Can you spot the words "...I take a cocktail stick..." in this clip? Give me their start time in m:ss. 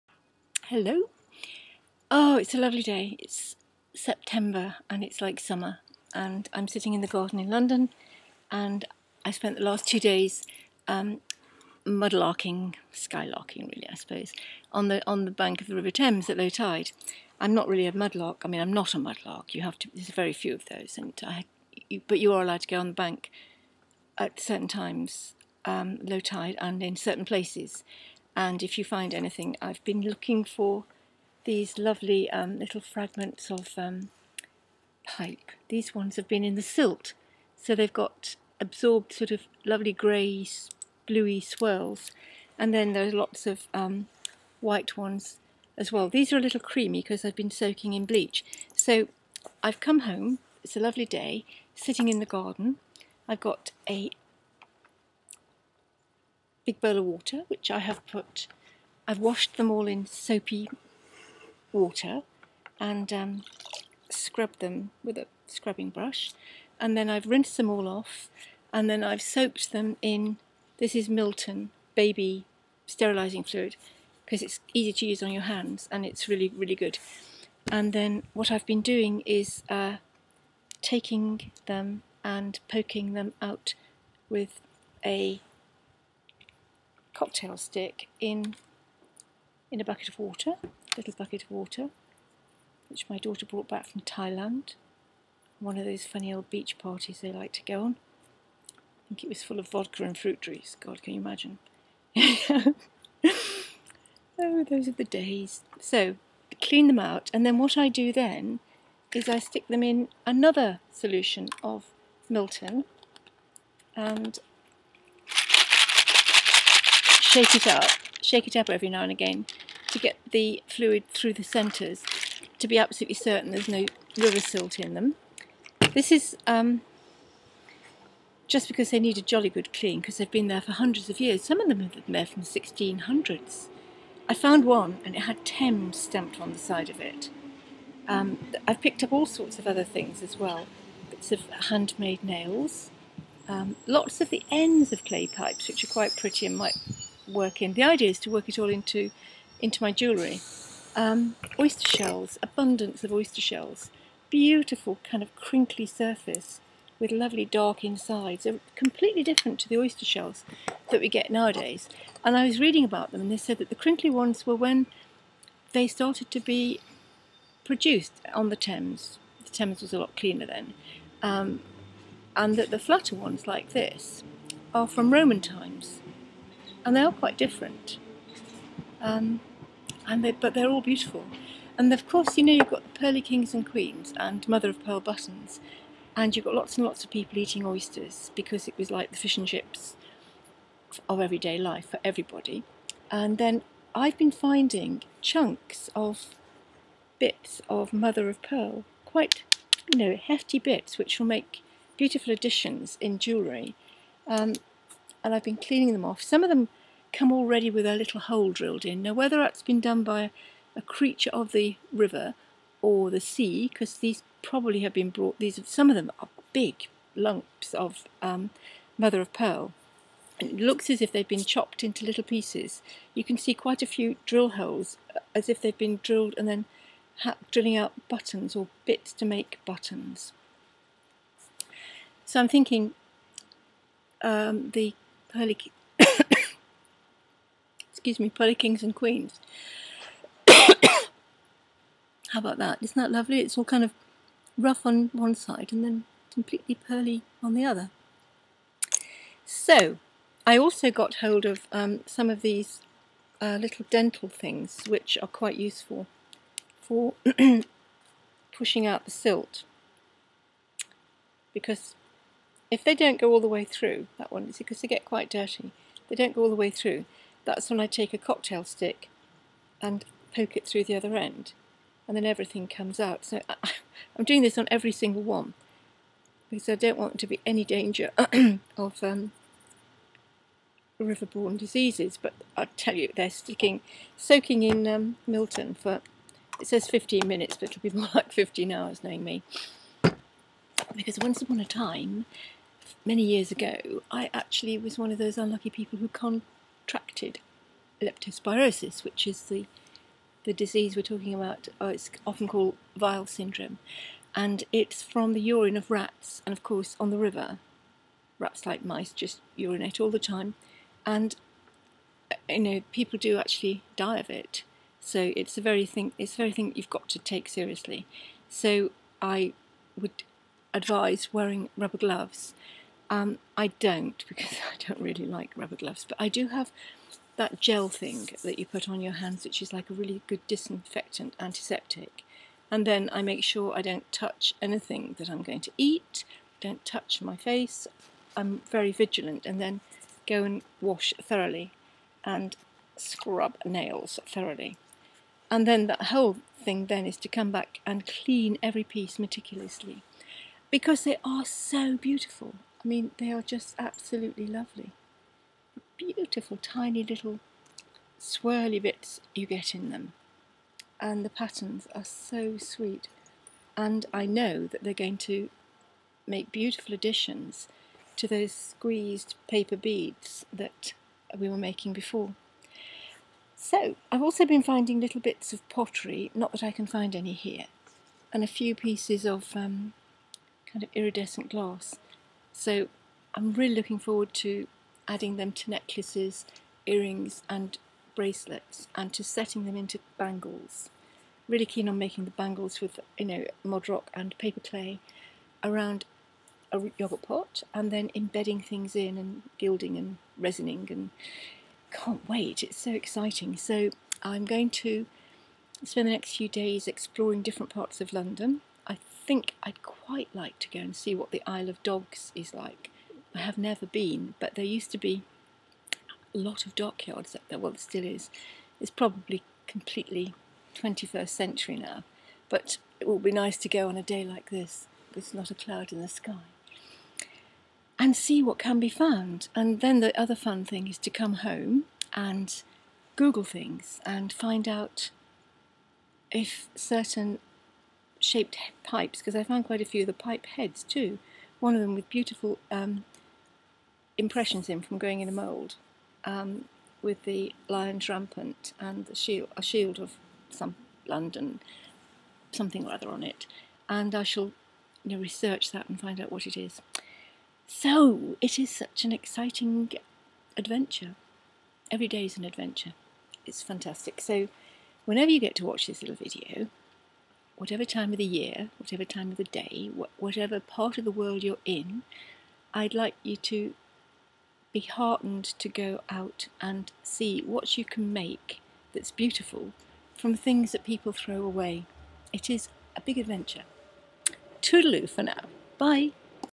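4:27.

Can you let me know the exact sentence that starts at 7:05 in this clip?
There's not a cloud in the sky.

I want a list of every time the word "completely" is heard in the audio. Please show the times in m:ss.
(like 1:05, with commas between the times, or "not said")
2:38, 4:06, 6:59.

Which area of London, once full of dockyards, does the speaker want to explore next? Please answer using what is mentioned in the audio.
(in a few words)
Isle of Dogs.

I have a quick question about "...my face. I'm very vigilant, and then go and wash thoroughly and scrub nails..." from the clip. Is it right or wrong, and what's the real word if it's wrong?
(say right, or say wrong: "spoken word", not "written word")
right.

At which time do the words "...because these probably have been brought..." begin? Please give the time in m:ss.
3:33.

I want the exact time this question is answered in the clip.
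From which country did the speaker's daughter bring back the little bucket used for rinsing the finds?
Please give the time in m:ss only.
1:34.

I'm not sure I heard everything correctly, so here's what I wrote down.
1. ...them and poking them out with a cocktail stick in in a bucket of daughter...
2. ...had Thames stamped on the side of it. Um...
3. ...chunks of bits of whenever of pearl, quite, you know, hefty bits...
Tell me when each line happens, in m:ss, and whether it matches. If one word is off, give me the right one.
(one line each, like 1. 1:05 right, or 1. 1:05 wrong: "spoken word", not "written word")
1. 1:21 wrong: "water", not "daughter"
2. 2:15 right
3. 3:15 wrong: "mother", not "whenever".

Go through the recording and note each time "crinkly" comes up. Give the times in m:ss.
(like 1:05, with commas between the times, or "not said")
2:35, 2:43.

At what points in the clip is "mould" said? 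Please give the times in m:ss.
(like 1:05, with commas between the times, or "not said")
7:25.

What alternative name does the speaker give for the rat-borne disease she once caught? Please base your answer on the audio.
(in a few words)
Weil syndrome.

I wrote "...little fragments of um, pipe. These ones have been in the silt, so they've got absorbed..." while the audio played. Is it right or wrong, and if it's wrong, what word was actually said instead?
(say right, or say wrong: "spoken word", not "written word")
right.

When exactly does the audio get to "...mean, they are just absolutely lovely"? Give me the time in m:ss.
5:52.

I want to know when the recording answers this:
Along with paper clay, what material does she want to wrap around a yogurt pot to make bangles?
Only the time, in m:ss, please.
6:33.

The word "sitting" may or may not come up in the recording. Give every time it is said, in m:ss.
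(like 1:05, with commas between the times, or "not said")
0:06, 0:51.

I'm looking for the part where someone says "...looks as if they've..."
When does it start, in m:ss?
3:40.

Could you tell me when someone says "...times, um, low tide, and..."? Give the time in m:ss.
0:24.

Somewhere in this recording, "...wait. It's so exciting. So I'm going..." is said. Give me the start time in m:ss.
6:42.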